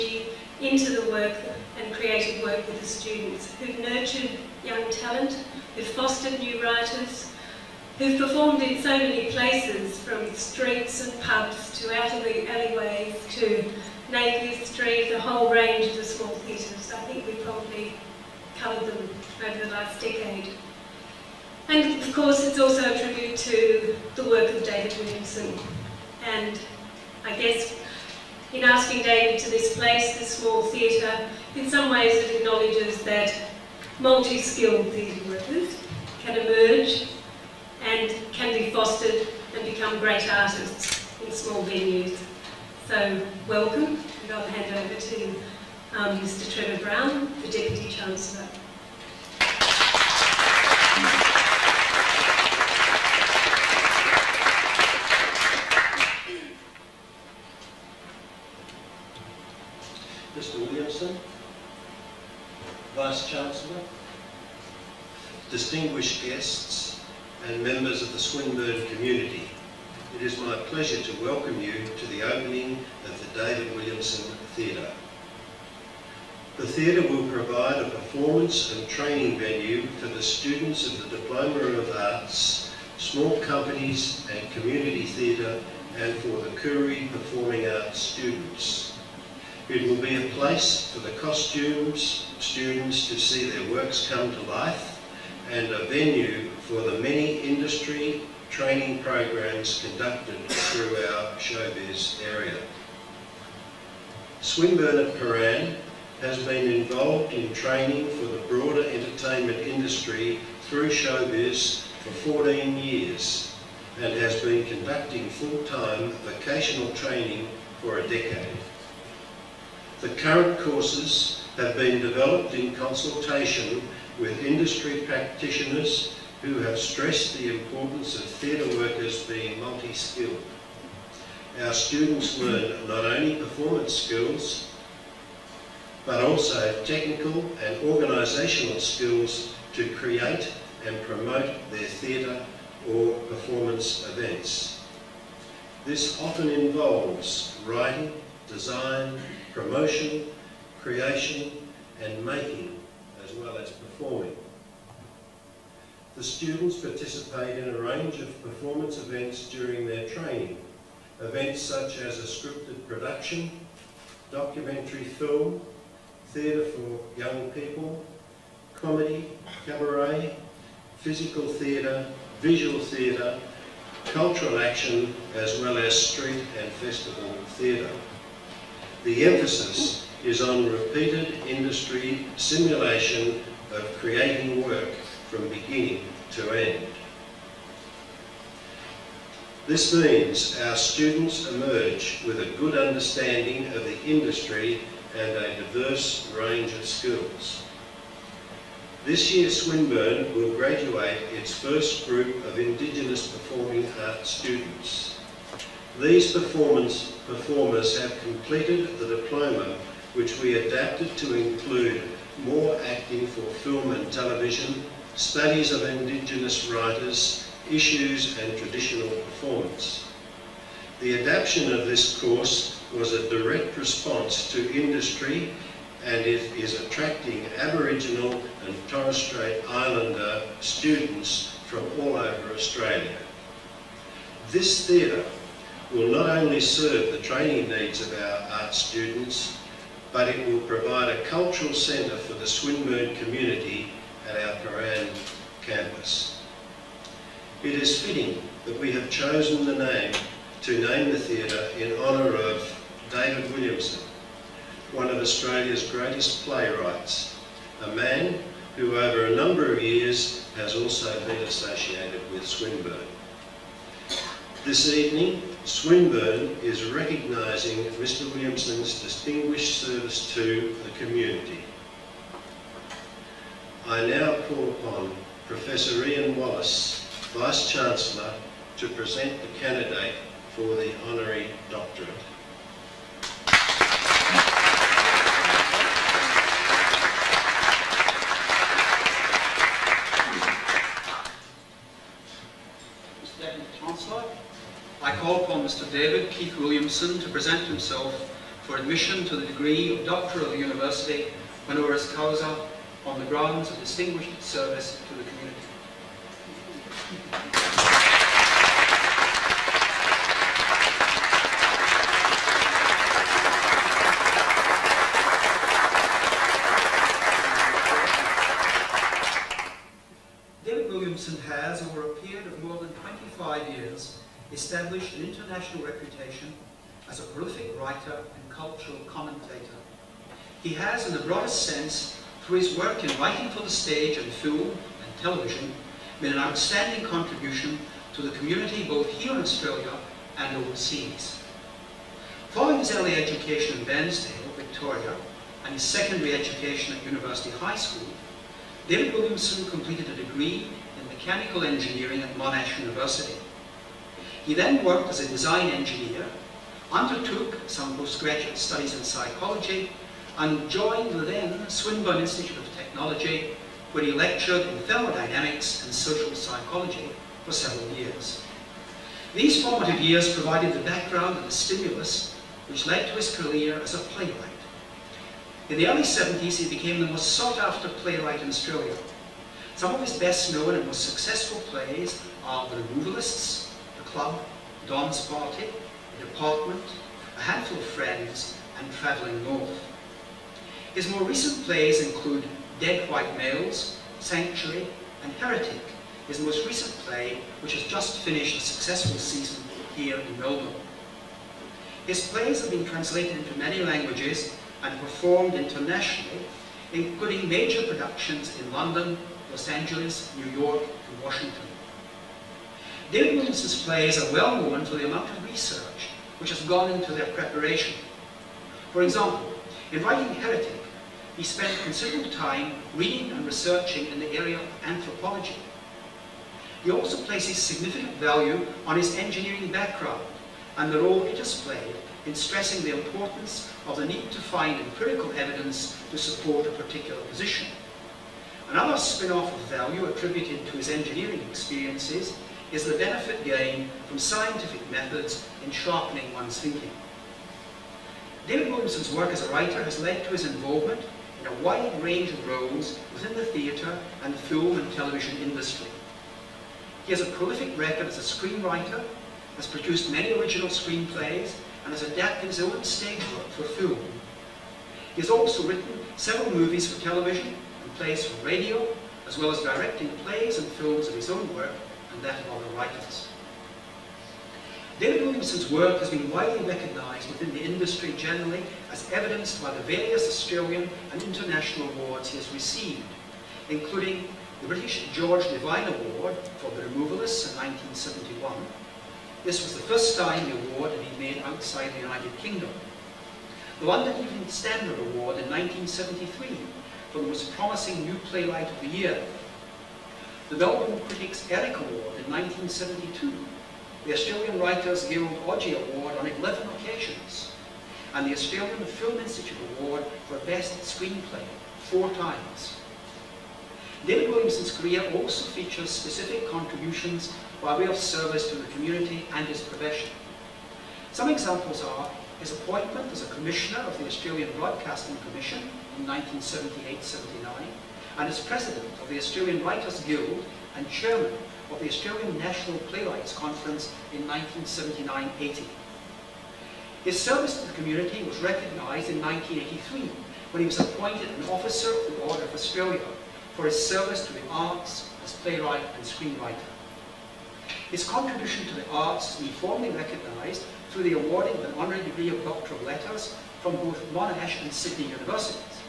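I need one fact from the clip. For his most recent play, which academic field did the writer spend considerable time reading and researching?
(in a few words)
anthropology.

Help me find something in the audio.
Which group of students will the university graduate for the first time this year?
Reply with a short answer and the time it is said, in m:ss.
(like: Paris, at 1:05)
Indigenous Performing Arts students, at 3:22.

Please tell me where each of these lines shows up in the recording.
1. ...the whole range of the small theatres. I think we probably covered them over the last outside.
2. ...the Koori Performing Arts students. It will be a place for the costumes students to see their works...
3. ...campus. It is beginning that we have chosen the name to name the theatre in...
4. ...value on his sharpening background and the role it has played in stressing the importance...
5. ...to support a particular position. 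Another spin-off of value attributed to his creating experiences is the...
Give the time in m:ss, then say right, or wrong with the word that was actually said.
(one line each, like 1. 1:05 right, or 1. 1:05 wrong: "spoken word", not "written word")
1. 0:15 wrong: "decade", not "outside"
2. 1:26 right
3. 4:05 wrong: "fitting", not "beginning"
4. 7:08 wrong: "engineering", not "sharpening"
5. 7:16 wrong: "engineering", not "creating".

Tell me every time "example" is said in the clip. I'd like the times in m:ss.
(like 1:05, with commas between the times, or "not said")
6:59, 8:41.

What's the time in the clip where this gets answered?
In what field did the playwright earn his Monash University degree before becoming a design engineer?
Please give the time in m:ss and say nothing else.
5:51.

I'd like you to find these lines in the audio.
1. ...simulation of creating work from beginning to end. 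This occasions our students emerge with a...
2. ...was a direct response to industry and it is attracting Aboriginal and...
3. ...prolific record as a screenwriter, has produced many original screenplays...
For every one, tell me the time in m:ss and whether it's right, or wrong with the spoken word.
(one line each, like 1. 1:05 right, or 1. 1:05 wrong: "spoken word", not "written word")
1. 3:02 wrong: "means", not "occasions"
2. 3:42 right
3. 7:37 right.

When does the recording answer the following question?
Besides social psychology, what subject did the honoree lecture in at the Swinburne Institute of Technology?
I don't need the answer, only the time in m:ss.
6:04.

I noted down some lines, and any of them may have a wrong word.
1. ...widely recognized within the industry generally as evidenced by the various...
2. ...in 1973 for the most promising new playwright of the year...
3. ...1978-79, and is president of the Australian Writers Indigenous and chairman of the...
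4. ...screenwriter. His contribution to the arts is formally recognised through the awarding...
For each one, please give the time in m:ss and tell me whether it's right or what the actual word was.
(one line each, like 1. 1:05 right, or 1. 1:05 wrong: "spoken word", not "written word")
1. 7:56 right
2. 8:15 right
3. 8:46 wrong: "Guild", not "Indigenous"
4. 9:06 right.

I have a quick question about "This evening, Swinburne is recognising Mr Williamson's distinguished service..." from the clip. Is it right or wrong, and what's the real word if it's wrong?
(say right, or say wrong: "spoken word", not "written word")
right.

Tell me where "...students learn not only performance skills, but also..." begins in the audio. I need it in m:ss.
2:11.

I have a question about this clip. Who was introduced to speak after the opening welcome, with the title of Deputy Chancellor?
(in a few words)
Trevor Brown.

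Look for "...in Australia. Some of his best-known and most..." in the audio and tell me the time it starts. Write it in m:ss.
6:18.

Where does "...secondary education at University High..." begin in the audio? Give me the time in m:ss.
5:45.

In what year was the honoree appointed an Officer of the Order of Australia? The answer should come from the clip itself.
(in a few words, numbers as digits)
1983.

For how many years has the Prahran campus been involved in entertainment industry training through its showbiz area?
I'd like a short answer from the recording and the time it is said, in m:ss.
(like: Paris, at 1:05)
14 years, at 1:52.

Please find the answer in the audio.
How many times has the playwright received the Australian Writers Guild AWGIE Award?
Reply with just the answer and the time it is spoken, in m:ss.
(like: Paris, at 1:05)
11, at 8:26.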